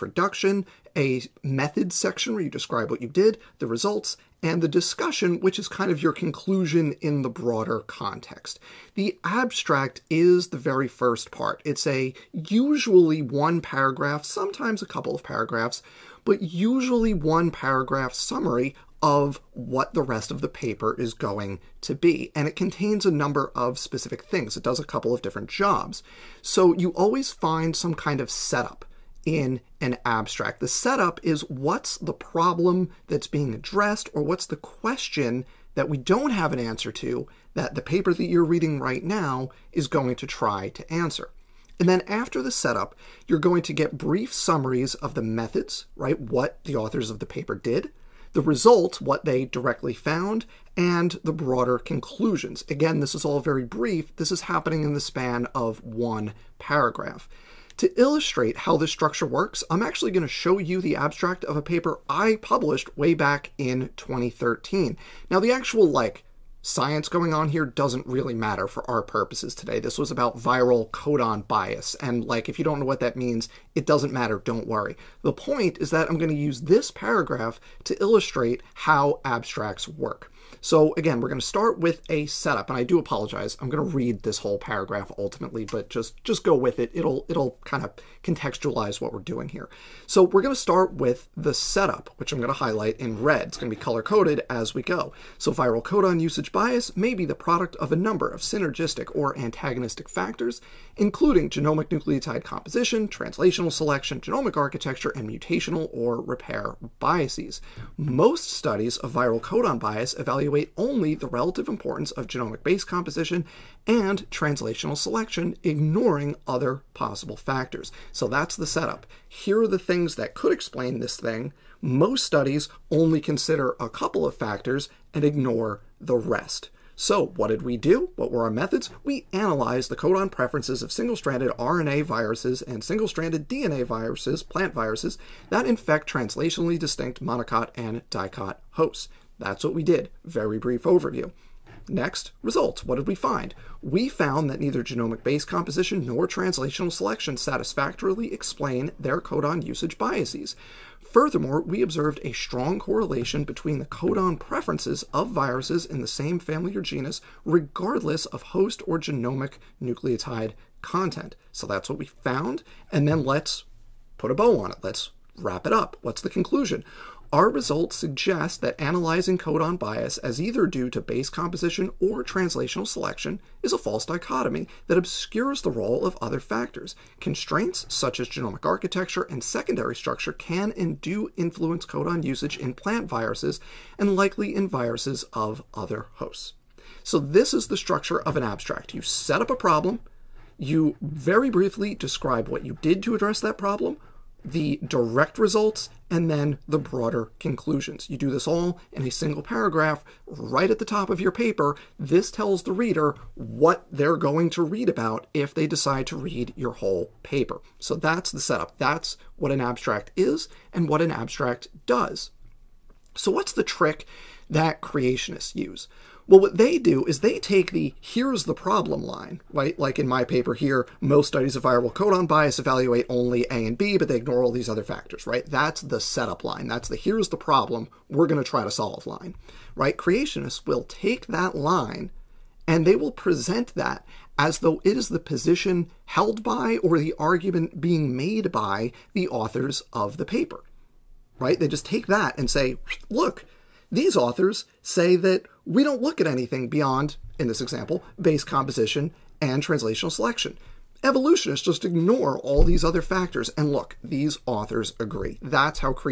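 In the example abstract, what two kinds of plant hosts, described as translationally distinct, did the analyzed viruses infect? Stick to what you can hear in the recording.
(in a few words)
monocot and dicot.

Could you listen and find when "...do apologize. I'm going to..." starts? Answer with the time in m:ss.
1:22.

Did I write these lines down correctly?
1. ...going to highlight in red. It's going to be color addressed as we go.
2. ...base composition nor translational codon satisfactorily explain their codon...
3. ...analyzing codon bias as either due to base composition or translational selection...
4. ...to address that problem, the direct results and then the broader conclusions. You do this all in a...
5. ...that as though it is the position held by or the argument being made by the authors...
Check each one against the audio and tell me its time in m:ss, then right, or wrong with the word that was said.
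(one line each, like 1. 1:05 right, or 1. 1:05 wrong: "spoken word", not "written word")
1. 1:32 wrong: "coded", not "addressed"
2. 2:25 wrong: "selection", not "codon"
3. 2:48 right
4. 3:13 right
5. 3:53 right.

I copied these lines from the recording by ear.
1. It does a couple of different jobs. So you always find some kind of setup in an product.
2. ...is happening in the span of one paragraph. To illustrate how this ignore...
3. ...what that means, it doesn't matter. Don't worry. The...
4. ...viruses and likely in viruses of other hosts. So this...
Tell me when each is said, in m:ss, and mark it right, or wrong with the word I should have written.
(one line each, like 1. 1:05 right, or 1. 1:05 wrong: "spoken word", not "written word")
1. 0:24 wrong: "abstract", not "product"
2. 0:54 wrong: "structure", not "ignore"
3. 1:12 right
4. 3:03 right.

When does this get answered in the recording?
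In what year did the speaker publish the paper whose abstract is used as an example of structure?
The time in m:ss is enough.
1:03.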